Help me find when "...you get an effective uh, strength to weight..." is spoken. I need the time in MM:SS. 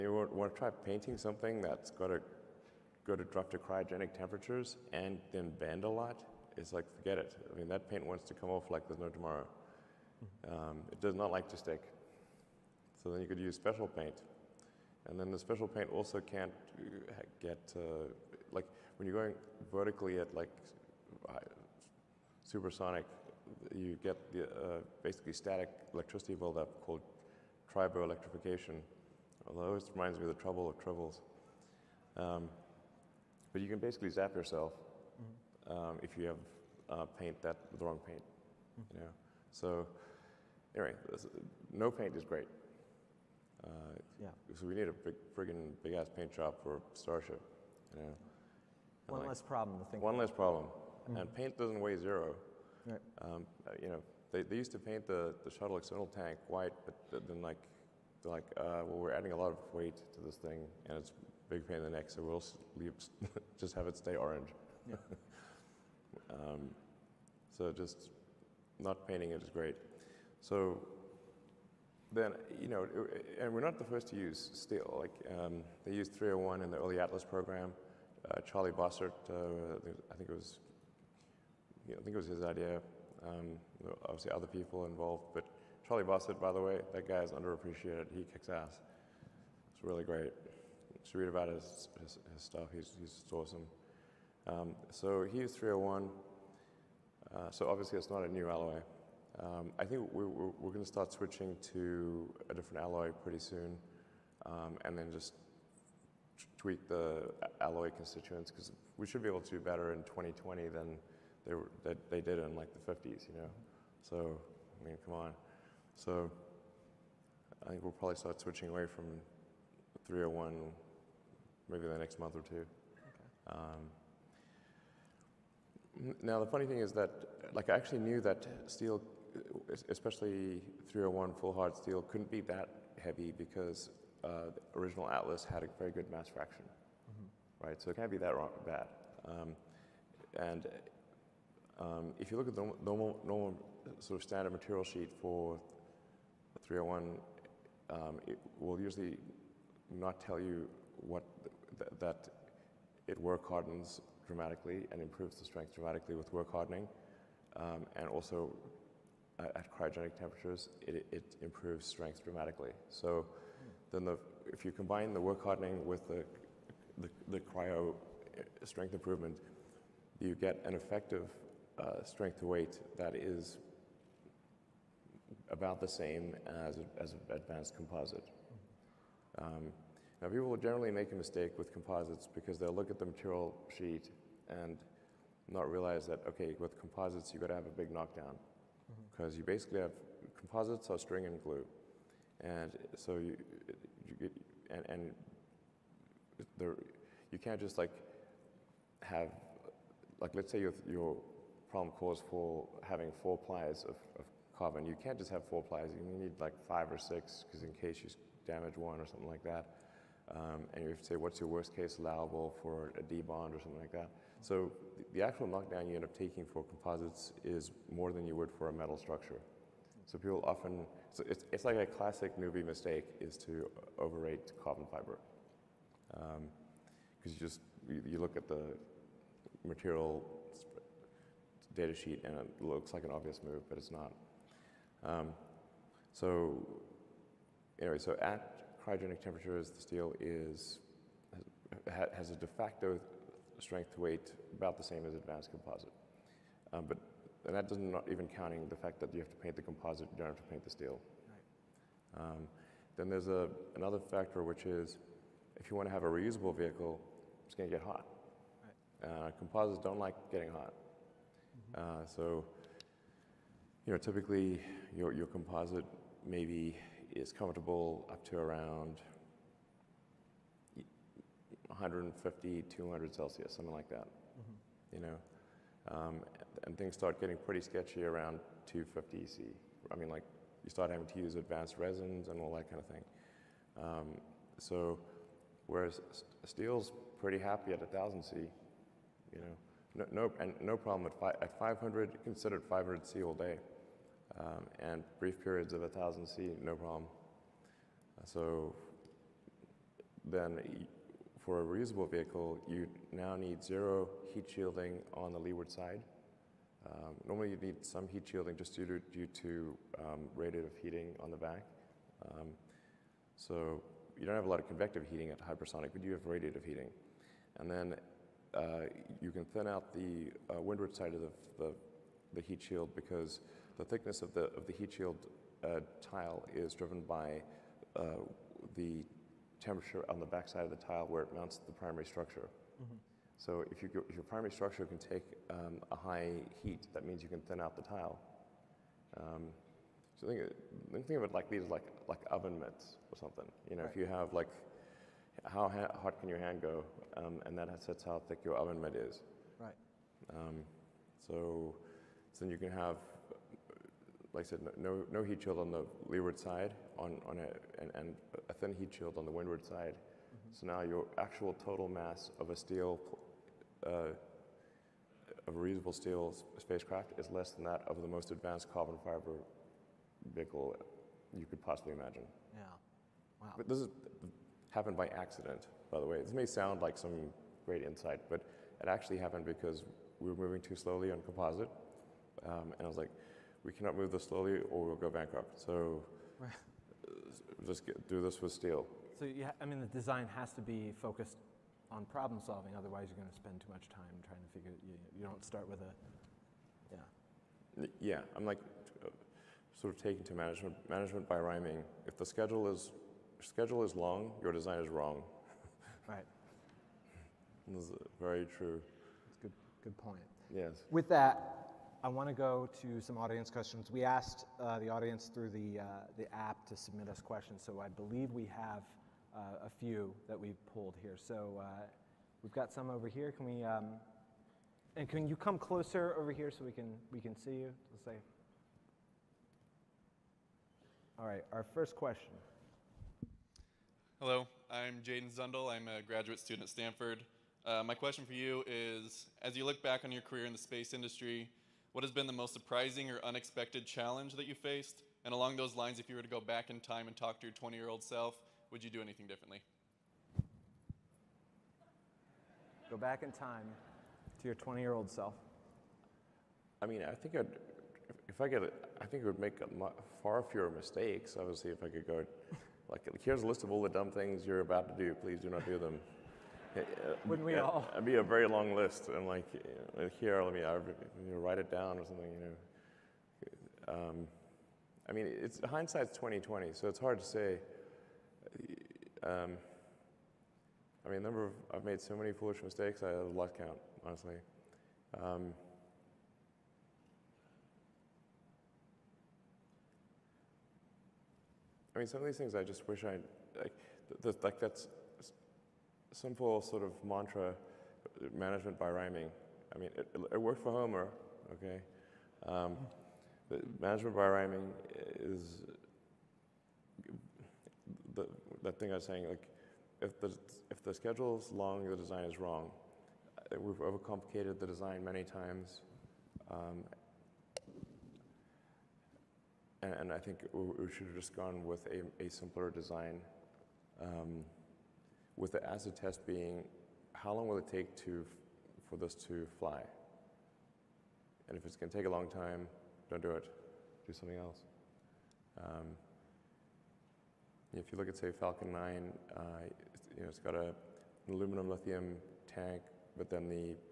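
02:50.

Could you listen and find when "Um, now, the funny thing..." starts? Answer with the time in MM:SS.
02:03.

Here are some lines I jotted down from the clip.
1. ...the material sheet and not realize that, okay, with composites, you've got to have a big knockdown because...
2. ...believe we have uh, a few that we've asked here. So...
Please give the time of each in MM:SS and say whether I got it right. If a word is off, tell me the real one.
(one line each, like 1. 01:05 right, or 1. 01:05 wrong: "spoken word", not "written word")
1. 03:02 right
2. 06:57 wrong: "pulled", not "asked".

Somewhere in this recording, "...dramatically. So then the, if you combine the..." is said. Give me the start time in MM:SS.
02:42.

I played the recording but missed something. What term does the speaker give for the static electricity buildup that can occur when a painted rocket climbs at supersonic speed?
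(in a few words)
triboelectrification.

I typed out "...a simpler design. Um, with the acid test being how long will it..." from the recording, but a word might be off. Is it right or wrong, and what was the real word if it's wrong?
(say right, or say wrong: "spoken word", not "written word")
right.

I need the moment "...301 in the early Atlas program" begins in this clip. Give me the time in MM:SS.
01:16.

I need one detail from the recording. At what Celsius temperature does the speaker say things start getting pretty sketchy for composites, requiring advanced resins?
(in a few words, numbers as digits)
250 C.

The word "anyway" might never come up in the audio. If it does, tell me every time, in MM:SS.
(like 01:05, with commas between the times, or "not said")
00:40, 03:57.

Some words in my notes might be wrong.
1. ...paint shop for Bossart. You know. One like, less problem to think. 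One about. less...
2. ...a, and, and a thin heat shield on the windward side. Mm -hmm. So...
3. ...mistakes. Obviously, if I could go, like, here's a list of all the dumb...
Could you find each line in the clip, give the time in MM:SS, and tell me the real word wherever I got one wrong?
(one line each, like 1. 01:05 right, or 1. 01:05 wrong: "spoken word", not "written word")
1. 00:46 wrong: "Starship", not "Bossart"
2. 05:57 right
3. 07:40 right.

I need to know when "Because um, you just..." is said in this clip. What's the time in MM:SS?
03:46.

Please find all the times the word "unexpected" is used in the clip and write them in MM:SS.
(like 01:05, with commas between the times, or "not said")
07:23.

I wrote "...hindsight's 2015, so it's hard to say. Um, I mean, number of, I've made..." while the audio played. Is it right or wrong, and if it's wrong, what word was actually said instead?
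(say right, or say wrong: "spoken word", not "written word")
wrong: "2020", not "2015".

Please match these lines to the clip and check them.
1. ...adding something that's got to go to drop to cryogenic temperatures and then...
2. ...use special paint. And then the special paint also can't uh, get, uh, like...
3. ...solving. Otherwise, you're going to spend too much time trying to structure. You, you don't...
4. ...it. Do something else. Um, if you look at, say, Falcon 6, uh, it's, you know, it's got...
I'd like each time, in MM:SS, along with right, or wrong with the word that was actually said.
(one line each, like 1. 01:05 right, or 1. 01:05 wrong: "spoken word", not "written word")
1. 00:00 wrong: "painting", not "adding"
2. 00:13 right
3. 06:32 wrong: "figure", not "structure"
4. 08:53 wrong: "9", not "6".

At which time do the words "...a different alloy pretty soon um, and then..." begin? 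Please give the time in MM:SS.
01:42.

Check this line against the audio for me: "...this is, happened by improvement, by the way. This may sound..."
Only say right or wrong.
wrong.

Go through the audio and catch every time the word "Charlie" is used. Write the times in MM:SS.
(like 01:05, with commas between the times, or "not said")
01:18, 01:25.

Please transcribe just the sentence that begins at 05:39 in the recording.
Um, so think, think of it like these, like like oven mitts or something.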